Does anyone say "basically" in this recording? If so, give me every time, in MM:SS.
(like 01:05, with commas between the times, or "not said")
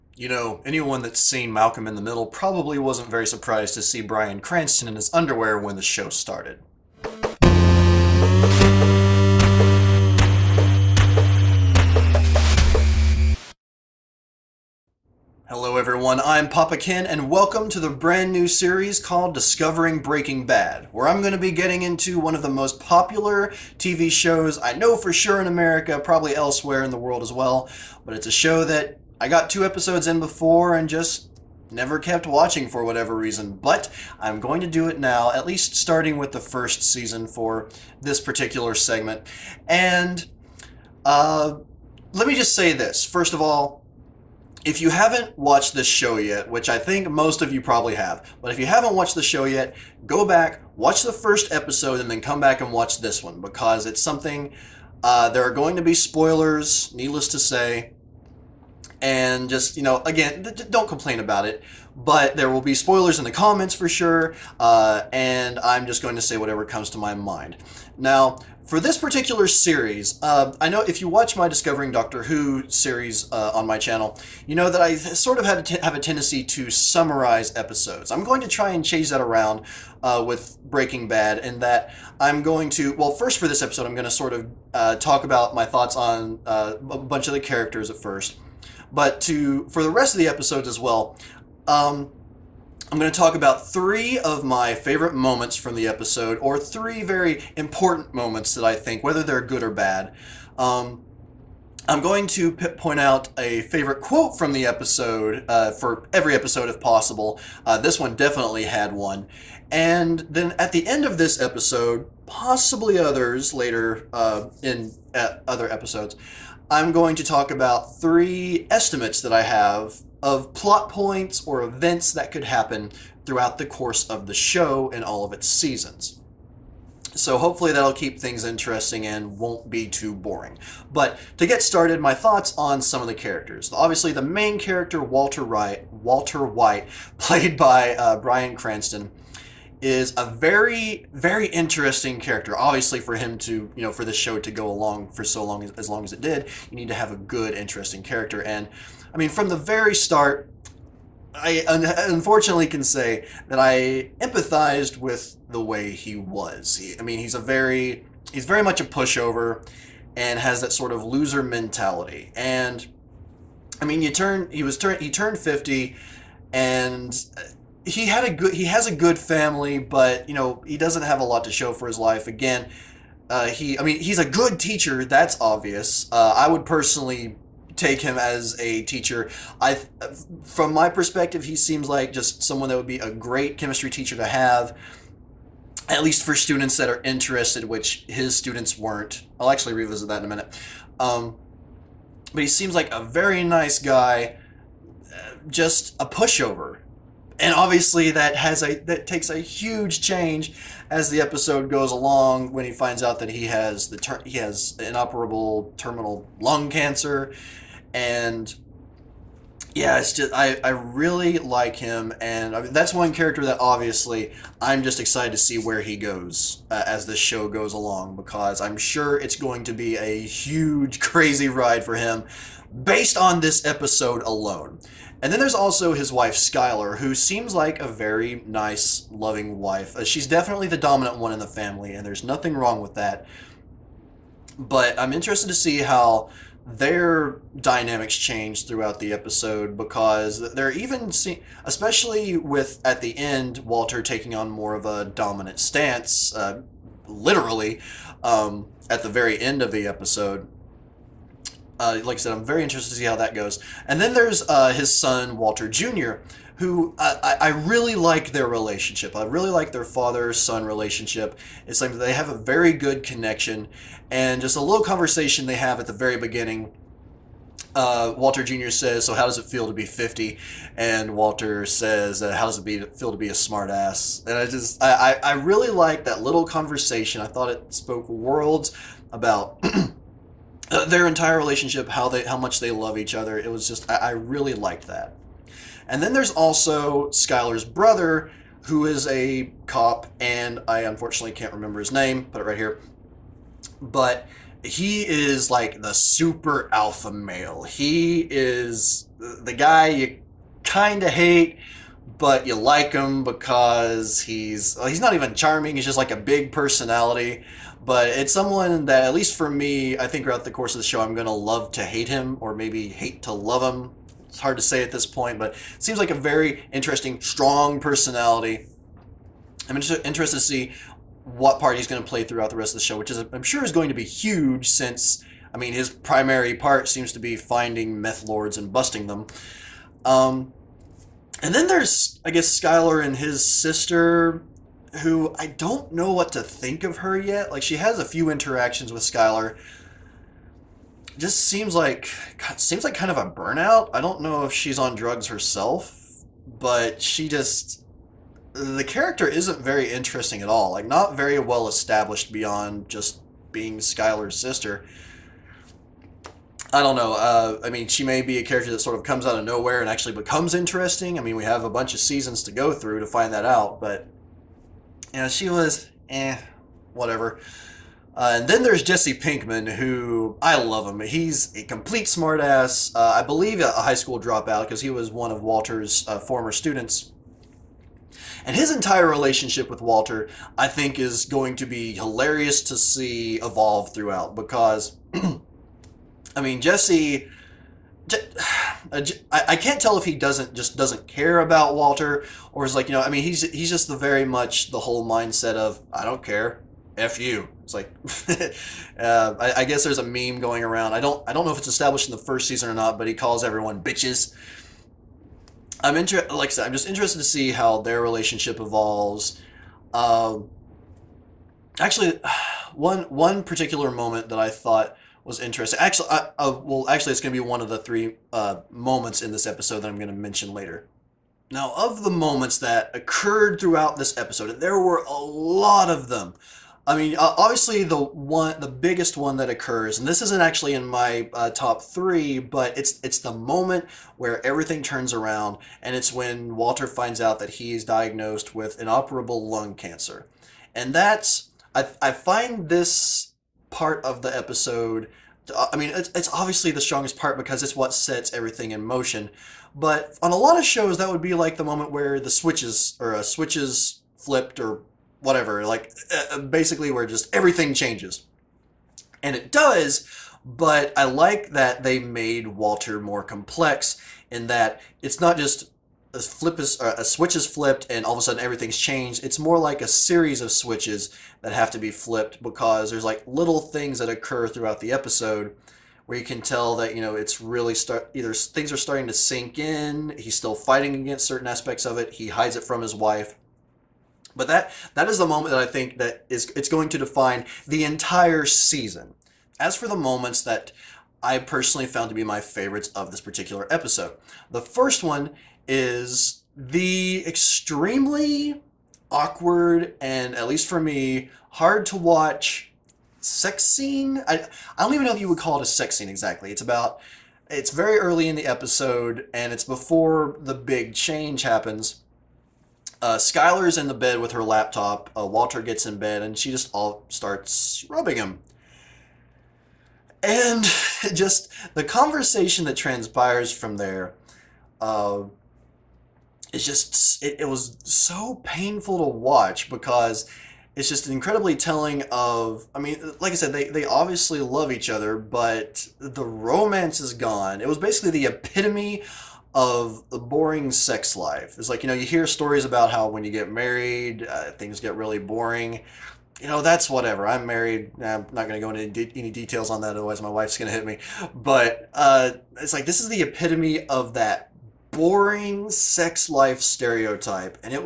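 07:36, 08:57.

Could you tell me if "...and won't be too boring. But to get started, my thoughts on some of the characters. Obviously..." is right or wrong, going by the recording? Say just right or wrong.
right.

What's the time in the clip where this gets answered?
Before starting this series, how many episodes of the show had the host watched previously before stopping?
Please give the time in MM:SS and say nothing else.
00:29.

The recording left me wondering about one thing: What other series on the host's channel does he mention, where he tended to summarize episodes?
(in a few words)
Discovering Doctor Who.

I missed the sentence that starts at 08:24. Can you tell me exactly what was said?
I I don't even know if you would call it a sex scene exactly.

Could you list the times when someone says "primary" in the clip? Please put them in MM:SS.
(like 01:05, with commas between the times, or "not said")
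05:25.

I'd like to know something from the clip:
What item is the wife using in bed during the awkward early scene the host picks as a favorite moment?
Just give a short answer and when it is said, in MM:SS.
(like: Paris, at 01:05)
Laptop, at 08:34.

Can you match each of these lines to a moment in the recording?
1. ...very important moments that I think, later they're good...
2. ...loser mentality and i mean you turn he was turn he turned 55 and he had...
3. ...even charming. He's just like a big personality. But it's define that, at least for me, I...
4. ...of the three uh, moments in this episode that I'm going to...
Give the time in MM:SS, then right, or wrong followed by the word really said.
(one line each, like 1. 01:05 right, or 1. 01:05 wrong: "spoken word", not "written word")
1. 01:37 wrong: "whether", not "later"
2. 02:41 wrong: "50", not "55"
3. 05:05 wrong: "someone", not "define"
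4. 06:57 right.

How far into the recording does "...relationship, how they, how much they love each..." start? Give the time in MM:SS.
04:41.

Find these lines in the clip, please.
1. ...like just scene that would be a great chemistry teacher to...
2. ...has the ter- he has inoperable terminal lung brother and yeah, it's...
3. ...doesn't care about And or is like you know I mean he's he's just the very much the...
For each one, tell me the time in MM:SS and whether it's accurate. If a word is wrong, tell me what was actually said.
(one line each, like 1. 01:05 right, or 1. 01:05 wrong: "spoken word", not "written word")
1. 03:01 wrong: "someone", not "scene"
2. 03:23 wrong: "cancer", not "brother"
3. 06:30 wrong: "Walter", not "And".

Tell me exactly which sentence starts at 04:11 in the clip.
Uh, like I said, I'm very interested to see how that goes.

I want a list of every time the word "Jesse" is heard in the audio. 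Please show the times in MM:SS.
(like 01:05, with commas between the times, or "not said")
06:08, 06:26.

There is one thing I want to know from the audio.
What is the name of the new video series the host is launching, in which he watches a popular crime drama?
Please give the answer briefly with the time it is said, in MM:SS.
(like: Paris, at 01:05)
Discovering Breaking Bad, at 00:19.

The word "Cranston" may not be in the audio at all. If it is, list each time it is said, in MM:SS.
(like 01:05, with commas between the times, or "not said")
00:04, 02:18.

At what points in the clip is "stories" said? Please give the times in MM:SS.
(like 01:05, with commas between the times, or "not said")
09:02.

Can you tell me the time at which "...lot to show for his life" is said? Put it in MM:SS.
02:51.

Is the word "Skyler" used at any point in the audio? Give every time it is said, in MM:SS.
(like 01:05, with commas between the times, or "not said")
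03:46, 04:47, 05:32, 05:39, 05:53, 08:33.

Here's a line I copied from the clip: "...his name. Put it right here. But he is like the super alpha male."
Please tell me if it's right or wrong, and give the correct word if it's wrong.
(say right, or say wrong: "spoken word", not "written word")
right.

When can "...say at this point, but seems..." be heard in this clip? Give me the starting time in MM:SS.
05:14.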